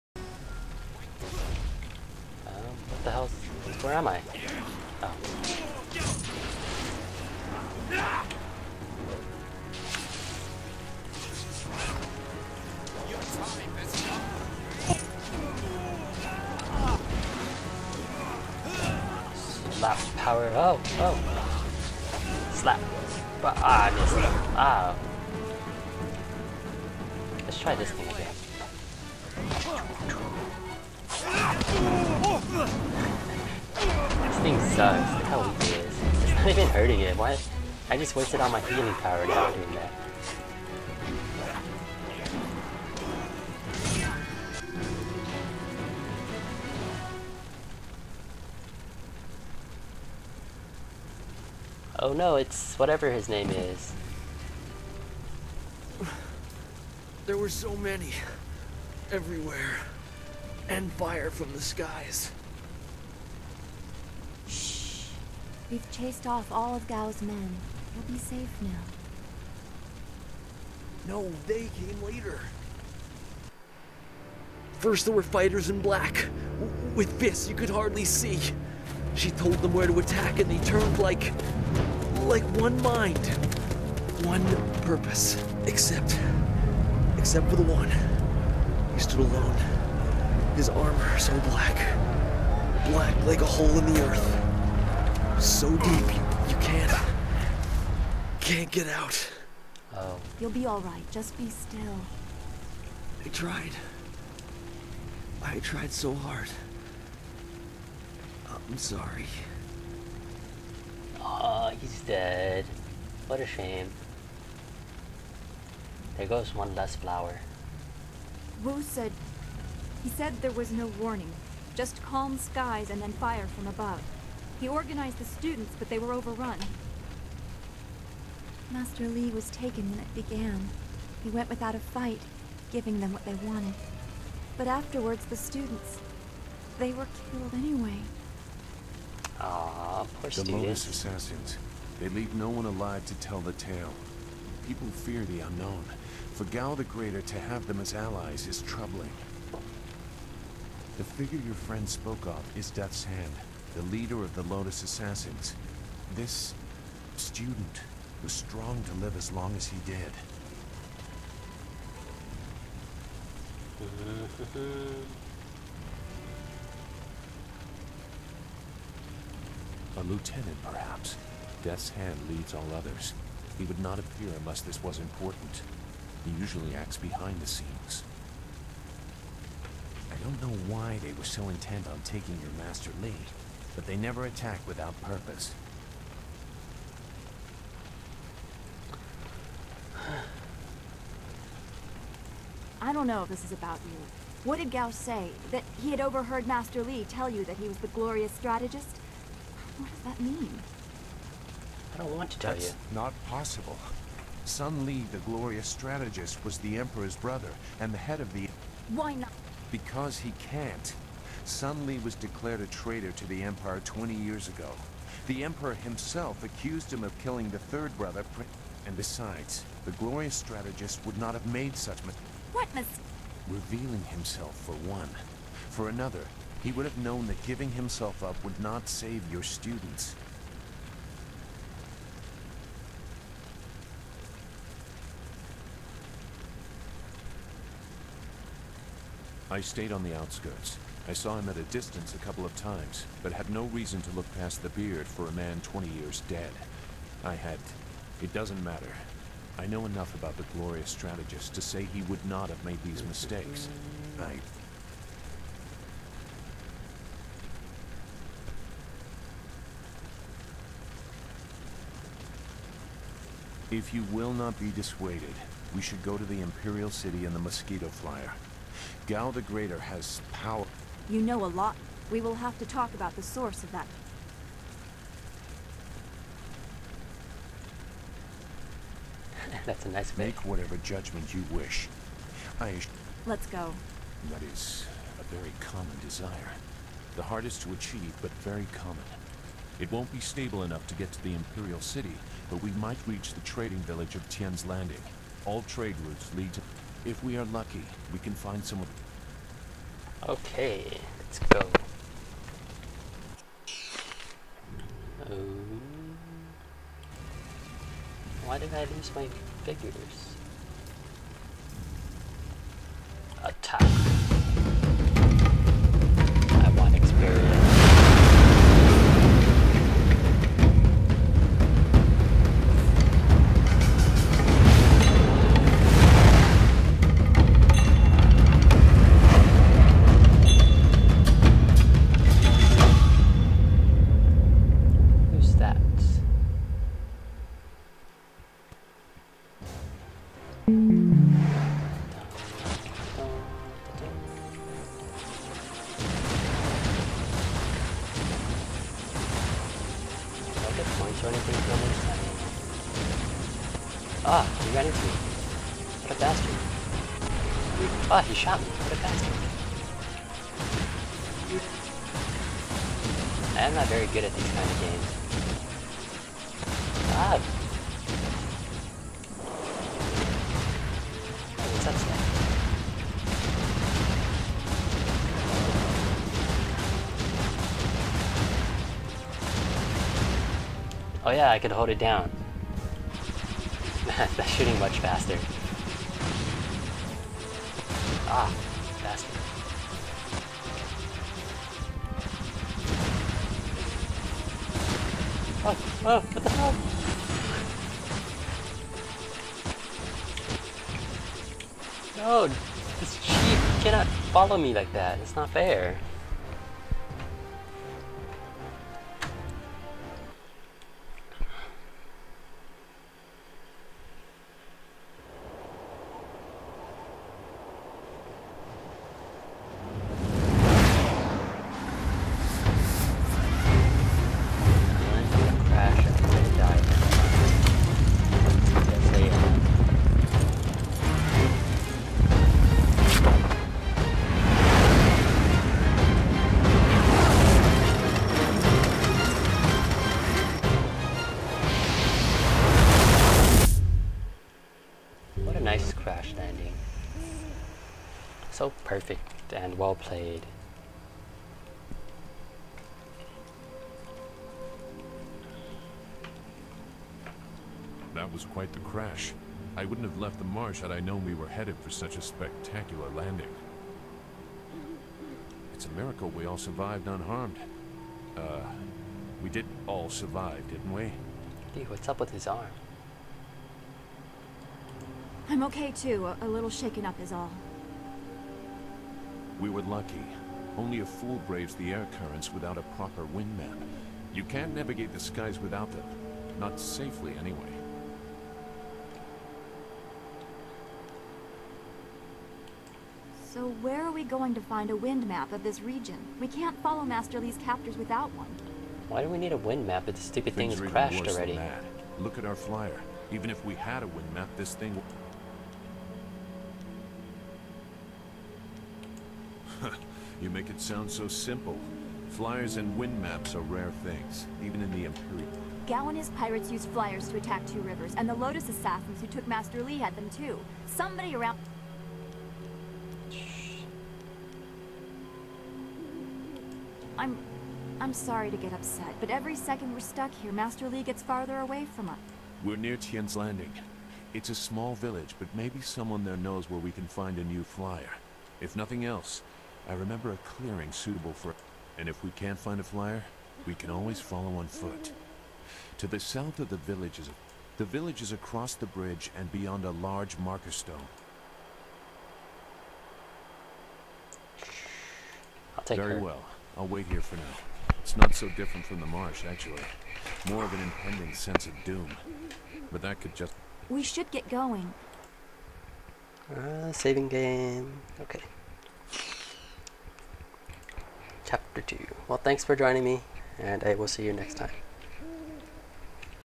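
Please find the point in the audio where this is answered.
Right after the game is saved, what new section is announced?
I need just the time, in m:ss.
9:31.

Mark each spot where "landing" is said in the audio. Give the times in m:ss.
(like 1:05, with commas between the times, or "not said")
4:54, 7:43, 8:53.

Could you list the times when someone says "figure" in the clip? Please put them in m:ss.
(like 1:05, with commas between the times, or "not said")
2:31, 5:09.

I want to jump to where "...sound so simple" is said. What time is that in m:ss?
8:30.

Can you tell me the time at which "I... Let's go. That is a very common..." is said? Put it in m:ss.
4:42.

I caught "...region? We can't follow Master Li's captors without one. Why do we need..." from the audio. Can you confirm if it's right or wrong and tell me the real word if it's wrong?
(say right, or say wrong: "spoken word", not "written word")
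right.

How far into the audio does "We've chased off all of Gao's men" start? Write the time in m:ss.
1:05.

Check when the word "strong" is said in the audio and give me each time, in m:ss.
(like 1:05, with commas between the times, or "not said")
2:38.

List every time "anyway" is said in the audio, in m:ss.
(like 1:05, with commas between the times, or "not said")
2:17, 8:07.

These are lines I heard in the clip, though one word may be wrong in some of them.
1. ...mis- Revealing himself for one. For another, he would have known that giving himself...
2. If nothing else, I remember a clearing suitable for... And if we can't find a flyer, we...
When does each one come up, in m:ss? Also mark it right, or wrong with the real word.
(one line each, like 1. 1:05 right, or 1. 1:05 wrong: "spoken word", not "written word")
1. 3:42 right
2. 8:58 right.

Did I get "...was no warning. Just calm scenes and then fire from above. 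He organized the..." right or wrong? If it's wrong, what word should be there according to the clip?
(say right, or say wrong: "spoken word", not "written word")
wrong: "skies", not "scenes".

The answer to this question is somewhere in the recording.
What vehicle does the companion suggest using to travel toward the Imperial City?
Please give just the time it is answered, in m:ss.
4:27.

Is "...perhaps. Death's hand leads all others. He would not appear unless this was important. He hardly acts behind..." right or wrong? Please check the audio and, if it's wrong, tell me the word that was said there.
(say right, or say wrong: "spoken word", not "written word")
wrong: "usually", not "hardly".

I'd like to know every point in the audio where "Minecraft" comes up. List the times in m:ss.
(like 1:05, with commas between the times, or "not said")
not said.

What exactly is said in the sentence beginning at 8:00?
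Only a fool braves the air currents without a proper wind map.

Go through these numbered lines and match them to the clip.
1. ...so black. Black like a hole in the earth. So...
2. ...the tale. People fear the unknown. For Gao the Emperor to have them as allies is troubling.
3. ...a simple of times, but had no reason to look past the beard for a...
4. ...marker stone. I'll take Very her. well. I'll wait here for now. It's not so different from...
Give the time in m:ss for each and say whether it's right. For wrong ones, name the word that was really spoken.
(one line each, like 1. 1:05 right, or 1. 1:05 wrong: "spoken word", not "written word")
1. 1:31 right
2. 2:23 wrong: "Greater", not "Emperor"
3. 4:02 wrong: "couple", not "simple"
4. 9:10 right.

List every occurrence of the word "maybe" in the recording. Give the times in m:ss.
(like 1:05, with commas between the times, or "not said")
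8:55.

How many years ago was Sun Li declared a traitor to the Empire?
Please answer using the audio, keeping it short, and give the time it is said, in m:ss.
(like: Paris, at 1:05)
20, at 3:33.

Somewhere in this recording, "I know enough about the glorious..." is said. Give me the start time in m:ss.
4:09.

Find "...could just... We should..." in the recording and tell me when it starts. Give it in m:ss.
9:23.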